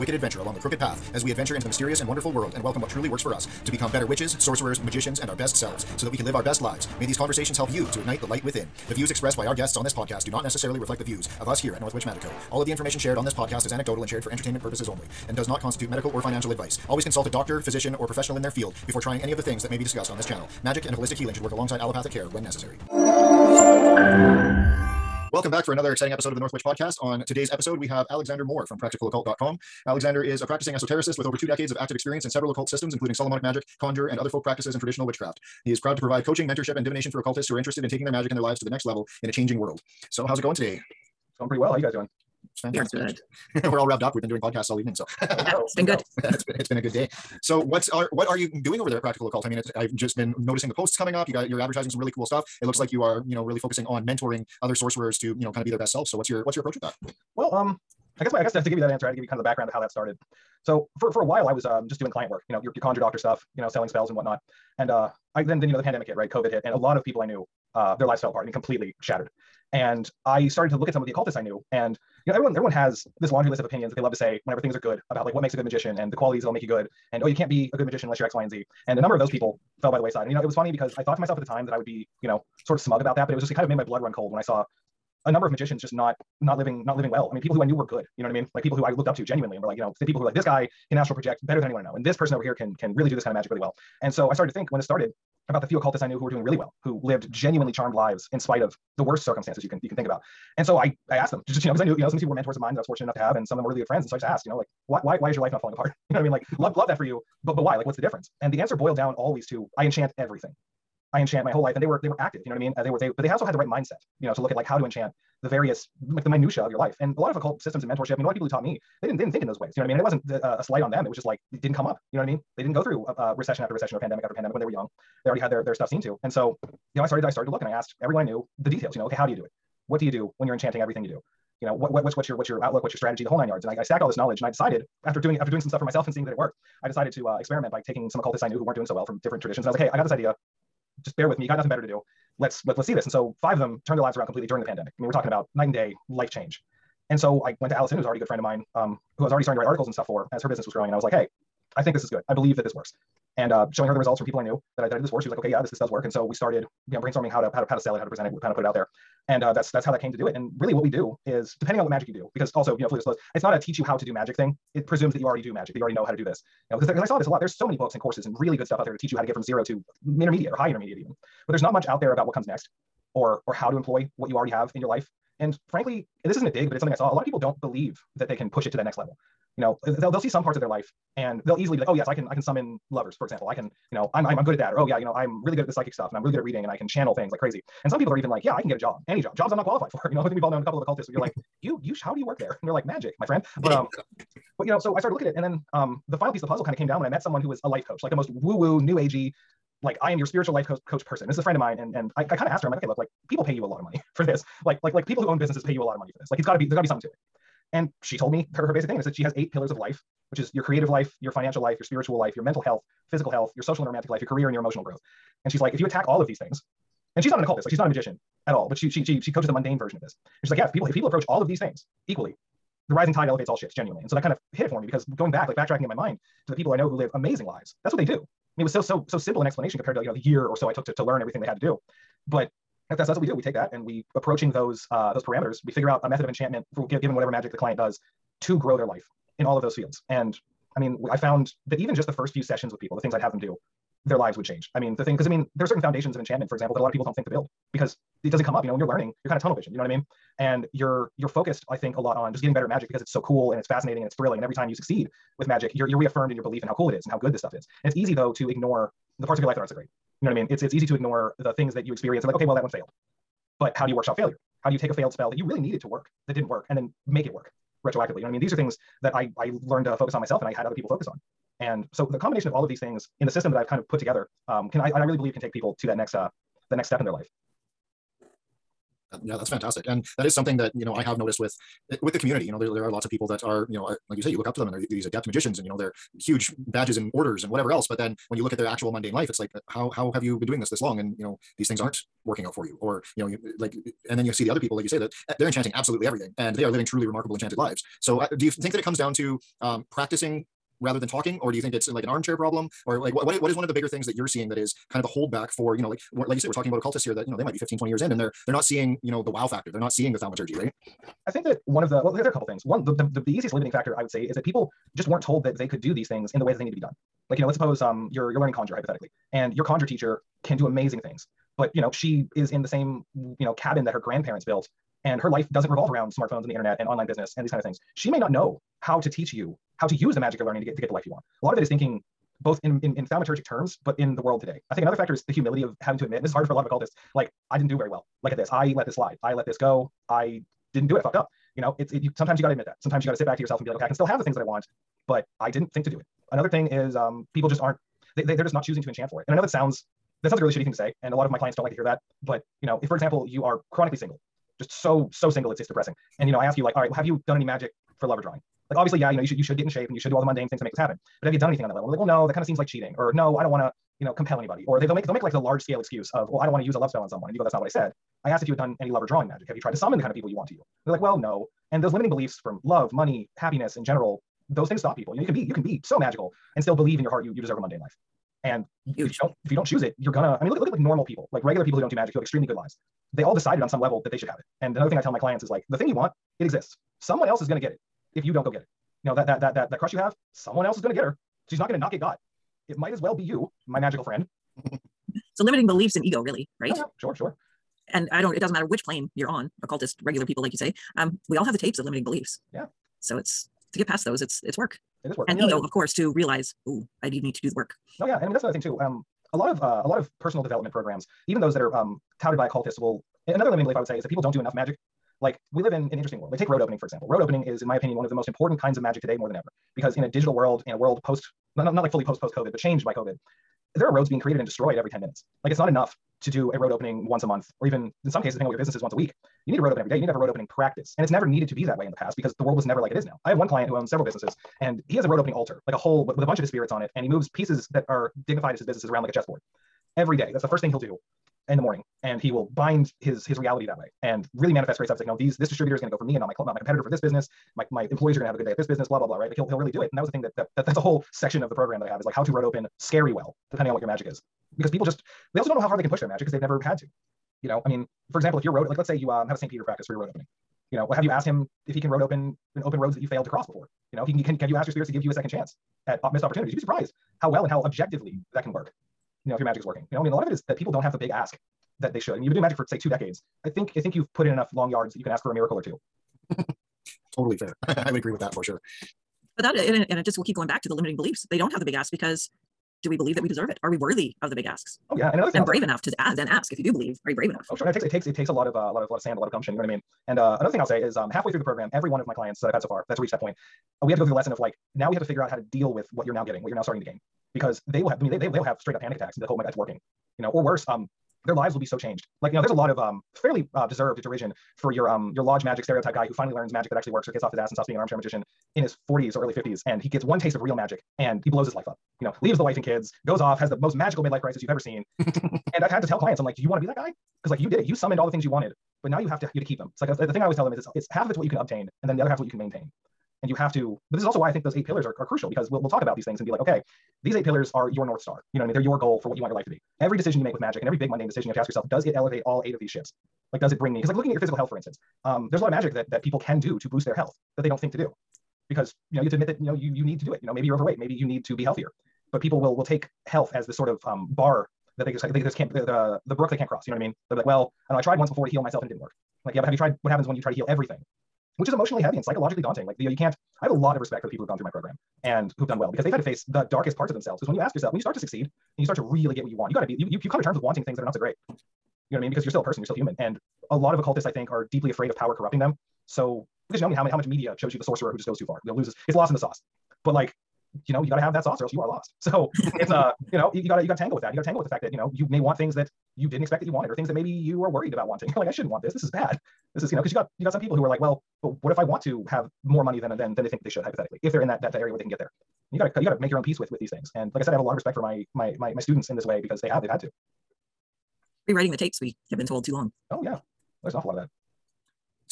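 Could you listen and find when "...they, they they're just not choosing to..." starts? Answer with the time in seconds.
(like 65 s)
348 s.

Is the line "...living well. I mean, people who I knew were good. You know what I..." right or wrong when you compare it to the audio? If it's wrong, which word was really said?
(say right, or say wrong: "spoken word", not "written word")
right.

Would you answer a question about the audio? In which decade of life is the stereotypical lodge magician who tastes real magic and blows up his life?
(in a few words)
his 40s.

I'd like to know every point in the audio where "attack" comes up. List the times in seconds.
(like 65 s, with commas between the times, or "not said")
215 s, 498 s.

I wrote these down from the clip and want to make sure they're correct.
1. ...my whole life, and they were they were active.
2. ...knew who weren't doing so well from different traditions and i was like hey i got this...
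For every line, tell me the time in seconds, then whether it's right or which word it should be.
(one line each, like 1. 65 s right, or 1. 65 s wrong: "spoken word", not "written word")
1. 111 s right
2. 138 s right.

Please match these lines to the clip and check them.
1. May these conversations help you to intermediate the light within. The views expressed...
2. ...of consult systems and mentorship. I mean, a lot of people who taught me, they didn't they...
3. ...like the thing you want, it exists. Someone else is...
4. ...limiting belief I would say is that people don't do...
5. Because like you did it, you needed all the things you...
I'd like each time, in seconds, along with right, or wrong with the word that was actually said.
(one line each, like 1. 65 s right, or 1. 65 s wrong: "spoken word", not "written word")
1. 6 s wrong: "ignite", not "intermediate"
2. 117 s wrong: "occult", not "consult"
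3. 385 s right
4. 413 s right
5. 517 s wrong: "summoned", not "needed".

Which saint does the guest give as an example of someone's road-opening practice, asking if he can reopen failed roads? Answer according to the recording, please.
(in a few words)
St. Peter.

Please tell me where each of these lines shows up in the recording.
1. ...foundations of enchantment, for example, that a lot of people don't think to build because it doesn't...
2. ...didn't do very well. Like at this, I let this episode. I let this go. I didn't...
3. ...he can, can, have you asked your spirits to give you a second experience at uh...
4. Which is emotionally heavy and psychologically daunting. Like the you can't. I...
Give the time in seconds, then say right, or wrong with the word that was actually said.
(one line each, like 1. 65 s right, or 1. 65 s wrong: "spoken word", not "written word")
1. 245 s right
2. 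337 s wrong: "slide", not "episode"
3. 464 s wrong: "chance", not "experience"
4. 551 s right.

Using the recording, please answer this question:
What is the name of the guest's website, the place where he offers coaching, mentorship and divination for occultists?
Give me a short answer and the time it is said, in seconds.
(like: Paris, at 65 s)
practicaloccult.com, at 28 s.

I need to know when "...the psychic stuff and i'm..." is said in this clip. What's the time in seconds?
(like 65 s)
185 s.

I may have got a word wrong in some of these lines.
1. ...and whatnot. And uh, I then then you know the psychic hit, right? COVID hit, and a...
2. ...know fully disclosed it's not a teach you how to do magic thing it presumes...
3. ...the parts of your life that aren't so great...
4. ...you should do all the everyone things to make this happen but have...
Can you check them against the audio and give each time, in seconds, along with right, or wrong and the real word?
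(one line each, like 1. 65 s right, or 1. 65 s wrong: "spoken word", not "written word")
1. 64 s wrong: "pandemic", not "psychic"
2. 162 s right
3. 259 s right
4. 359 s wrong: "mundane", not "everyone".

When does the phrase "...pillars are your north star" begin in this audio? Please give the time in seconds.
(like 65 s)
527 s.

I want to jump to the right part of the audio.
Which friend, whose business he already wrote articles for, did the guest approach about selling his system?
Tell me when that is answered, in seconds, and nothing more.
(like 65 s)
147 s.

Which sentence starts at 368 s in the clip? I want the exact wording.
I asked if you had done any lover drawing magic.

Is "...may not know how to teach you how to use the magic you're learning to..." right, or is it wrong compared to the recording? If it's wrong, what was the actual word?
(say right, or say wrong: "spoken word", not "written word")
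right.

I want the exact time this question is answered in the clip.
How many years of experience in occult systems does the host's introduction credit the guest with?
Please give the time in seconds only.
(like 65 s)
31 s.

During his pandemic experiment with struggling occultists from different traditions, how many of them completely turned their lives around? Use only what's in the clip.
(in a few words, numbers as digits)
5.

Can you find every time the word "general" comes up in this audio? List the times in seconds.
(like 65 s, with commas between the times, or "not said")
373 s.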